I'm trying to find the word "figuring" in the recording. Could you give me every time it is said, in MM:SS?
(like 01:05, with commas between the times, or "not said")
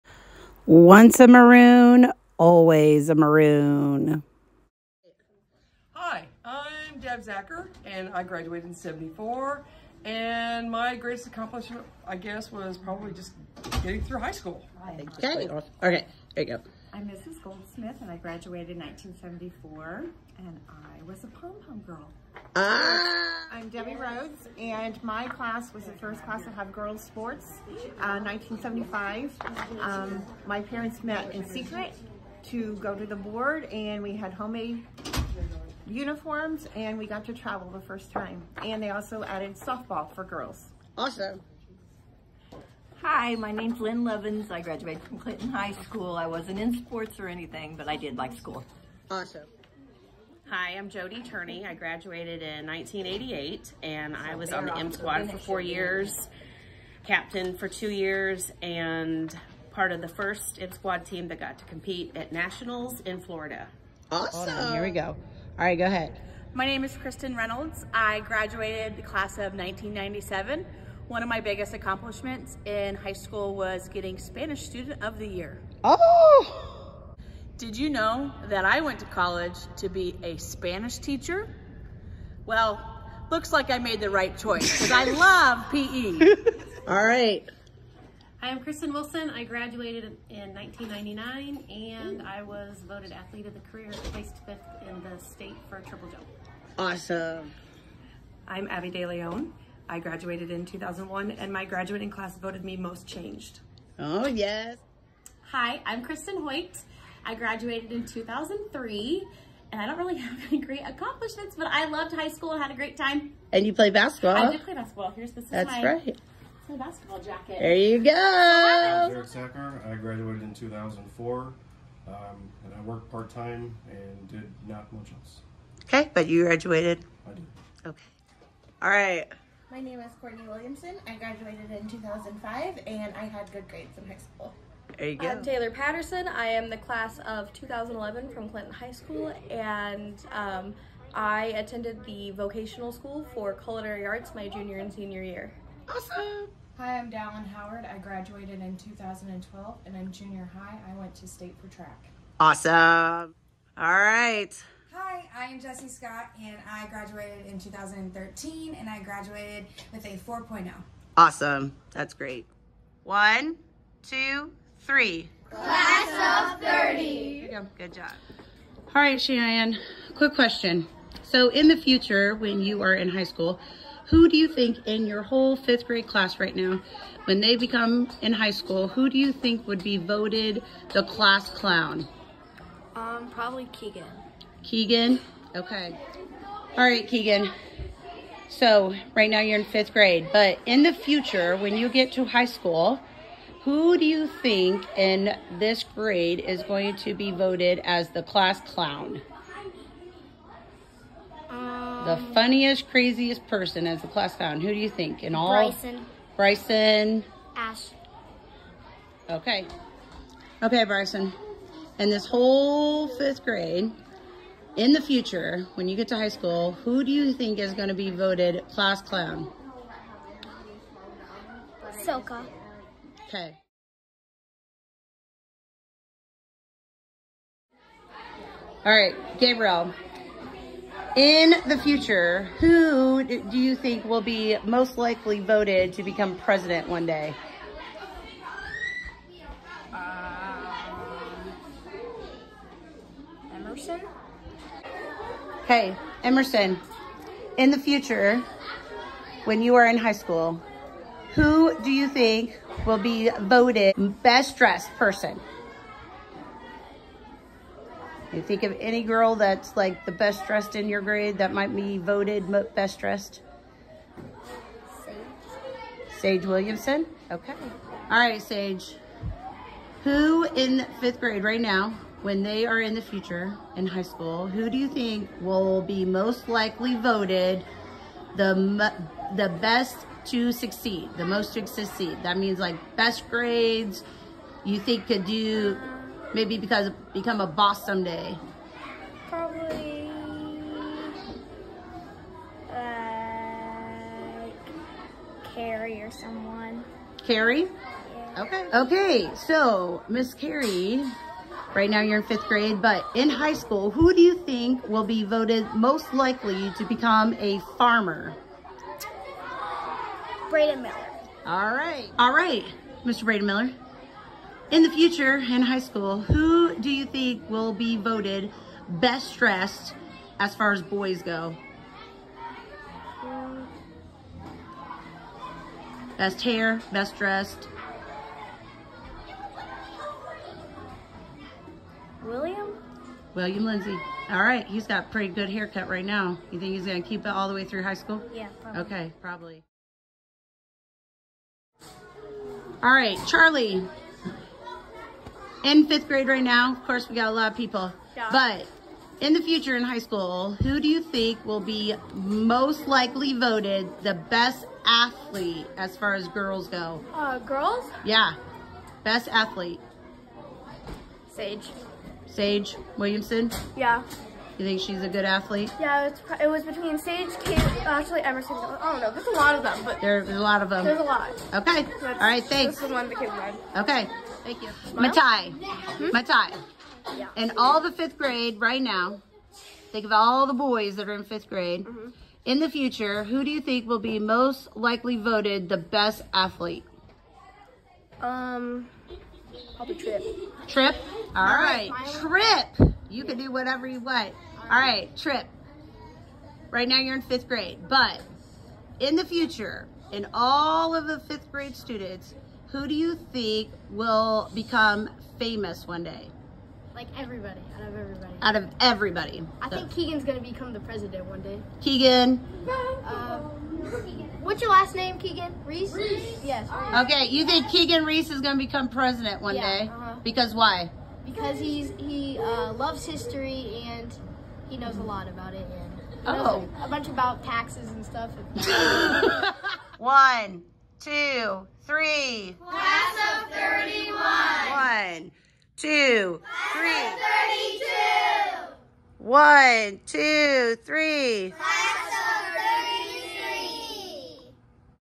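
not said.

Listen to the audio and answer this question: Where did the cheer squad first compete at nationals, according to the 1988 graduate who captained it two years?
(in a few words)
Florida.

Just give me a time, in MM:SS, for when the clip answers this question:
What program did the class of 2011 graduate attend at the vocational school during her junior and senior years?
02:23.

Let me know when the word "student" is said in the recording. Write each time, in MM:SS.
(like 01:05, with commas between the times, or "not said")
01:14, 06:41.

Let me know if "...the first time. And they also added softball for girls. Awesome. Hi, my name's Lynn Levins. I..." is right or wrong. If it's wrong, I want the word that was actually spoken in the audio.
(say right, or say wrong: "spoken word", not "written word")
right.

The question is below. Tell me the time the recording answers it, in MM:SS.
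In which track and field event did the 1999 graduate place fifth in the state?
01:35.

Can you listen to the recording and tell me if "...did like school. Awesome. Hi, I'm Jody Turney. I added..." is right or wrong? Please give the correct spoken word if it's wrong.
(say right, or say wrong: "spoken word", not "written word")
wrong: "graduated", not "added".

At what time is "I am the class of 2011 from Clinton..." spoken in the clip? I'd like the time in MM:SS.
02:16.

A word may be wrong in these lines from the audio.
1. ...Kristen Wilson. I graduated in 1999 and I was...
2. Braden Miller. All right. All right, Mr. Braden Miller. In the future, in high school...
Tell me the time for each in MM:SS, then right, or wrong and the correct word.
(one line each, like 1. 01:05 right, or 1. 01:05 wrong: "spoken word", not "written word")
1. 01:28 right
2. 05:10 right.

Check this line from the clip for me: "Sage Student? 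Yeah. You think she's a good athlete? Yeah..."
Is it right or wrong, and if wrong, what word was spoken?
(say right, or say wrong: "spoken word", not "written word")
wrong: "Williamson", not "Student".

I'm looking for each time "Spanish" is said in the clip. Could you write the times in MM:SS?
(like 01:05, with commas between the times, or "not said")
01:14, 01:20.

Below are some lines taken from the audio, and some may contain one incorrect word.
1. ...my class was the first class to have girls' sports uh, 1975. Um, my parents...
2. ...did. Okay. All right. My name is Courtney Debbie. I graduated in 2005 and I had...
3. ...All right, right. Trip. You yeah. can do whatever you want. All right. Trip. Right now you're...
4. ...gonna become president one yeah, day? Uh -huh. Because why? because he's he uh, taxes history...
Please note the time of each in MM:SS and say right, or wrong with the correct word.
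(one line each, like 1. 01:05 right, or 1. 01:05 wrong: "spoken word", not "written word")
1. 00:25 right
2. 02:07 wrong: "Williamson", not "Debbie"
3. 06:31 right
4. 06:58 wrong: "loves", not "taxes".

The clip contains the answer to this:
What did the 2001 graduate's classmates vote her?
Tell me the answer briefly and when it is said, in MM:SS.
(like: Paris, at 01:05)
most changed, at 01:42.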